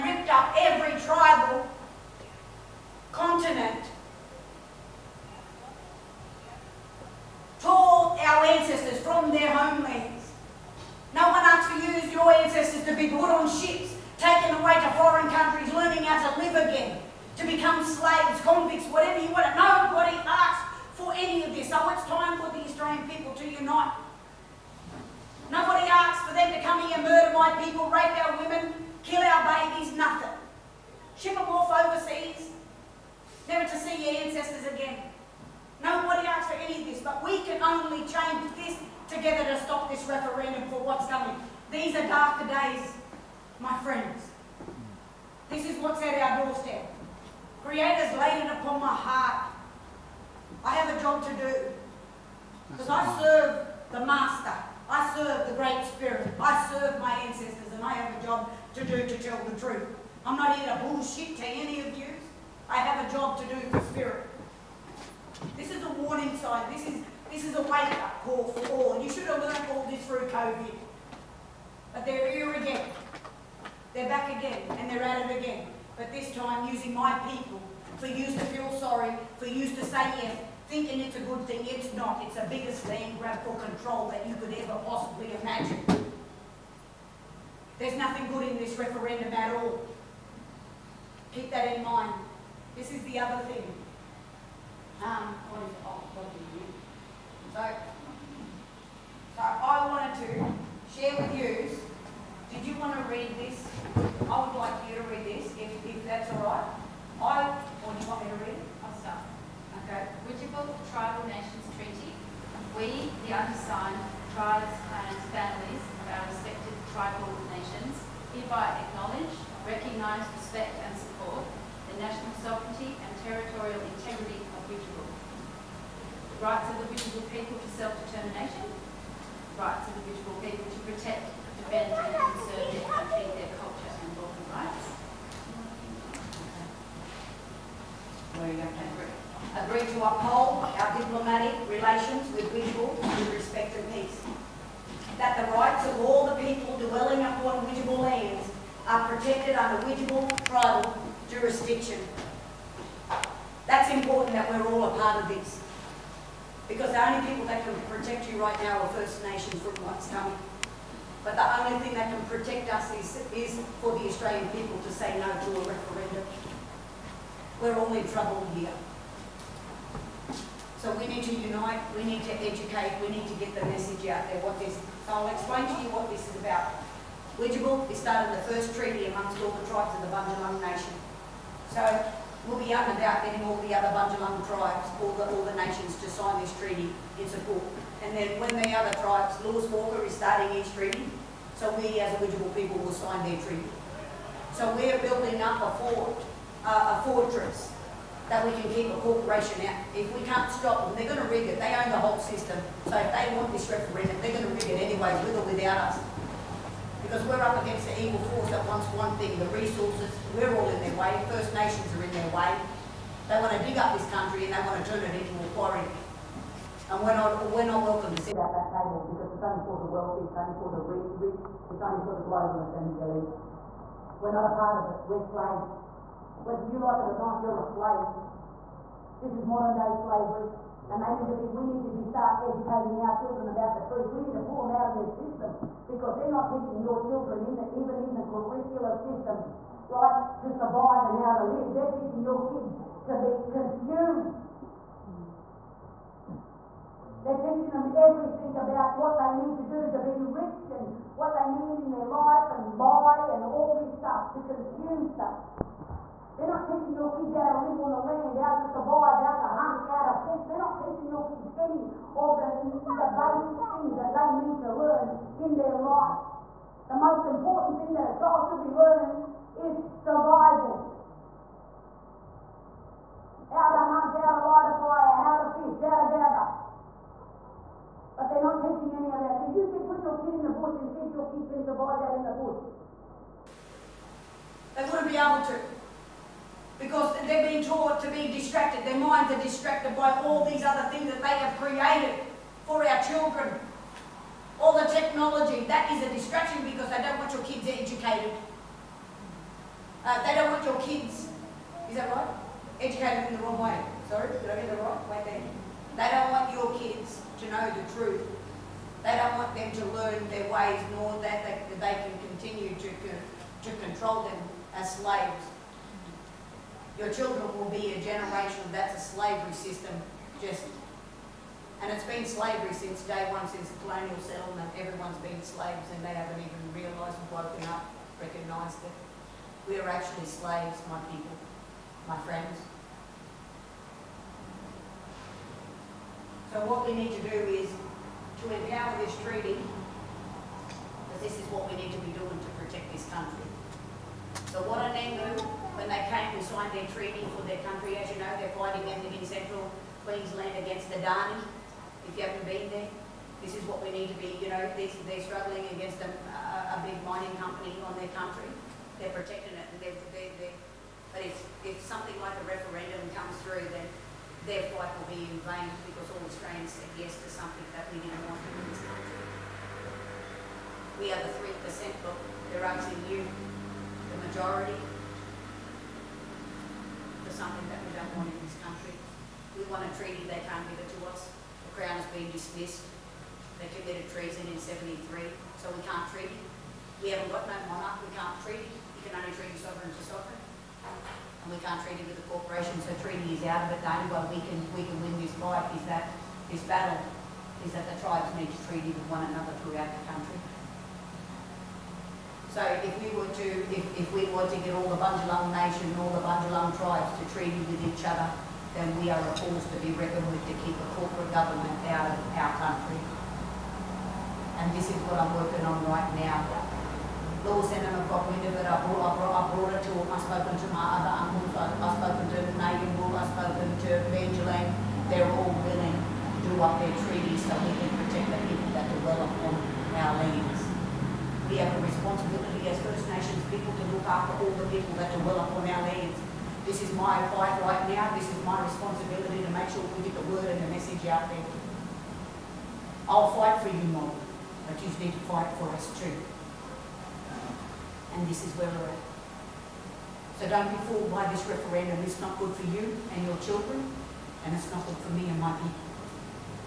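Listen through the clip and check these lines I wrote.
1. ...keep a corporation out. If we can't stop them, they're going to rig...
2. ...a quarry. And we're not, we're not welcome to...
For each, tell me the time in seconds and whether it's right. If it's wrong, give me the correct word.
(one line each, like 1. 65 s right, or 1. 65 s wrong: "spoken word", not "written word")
1. 198 s right
2. 215 s right.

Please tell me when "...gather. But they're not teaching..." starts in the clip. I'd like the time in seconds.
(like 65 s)
276 s.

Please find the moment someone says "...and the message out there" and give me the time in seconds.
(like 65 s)
440 s.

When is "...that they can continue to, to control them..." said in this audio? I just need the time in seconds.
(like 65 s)
311 s.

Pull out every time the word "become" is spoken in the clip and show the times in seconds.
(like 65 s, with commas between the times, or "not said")
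17 s.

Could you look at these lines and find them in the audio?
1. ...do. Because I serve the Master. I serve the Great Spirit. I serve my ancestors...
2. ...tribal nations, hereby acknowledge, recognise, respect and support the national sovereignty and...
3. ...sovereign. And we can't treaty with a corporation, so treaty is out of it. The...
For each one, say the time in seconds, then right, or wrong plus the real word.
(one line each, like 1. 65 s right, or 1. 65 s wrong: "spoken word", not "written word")
1. 51 s right
2. 116 s right
3. 390 s right.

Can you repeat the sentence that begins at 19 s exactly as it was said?
Nobody asked for any of this.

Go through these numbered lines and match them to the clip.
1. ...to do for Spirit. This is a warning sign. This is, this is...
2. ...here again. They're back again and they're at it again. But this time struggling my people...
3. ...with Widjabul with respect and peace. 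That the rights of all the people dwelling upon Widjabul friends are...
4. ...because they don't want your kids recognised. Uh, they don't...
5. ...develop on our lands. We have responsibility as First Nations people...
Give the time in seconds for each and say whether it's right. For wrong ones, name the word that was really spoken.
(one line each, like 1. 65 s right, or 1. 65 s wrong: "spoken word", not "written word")
1. 63 s right
2. 72 s wrong: "using", not "struggling"
3. 142 s wrong: "lands", not "friends"
4. 296 s wrong: "educated", not "recognised"
5. 428 s right.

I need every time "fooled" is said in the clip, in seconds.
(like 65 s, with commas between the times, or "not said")
450 s.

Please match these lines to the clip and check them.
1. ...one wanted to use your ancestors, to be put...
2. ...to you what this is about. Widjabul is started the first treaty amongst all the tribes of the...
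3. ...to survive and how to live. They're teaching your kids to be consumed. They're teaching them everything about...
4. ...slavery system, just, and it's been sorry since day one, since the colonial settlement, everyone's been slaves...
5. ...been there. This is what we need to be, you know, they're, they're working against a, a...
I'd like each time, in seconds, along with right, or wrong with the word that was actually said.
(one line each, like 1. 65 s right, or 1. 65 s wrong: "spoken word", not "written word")
1. 11 s wrong: "asked", not "wanted"
2. 175 s right
3. 240 s right
4. 319 s wrong: "slavery", not "sorry"
5. 352 s wrong: "struggling", not "working".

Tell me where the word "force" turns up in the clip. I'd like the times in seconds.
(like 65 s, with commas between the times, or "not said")
208 s, 409 s.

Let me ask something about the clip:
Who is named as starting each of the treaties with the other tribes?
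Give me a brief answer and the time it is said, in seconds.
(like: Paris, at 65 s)
Lewis Walker, at 189 s.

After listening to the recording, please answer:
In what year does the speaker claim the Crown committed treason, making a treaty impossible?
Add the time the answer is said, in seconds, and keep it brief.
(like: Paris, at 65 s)
1973, at 384 s.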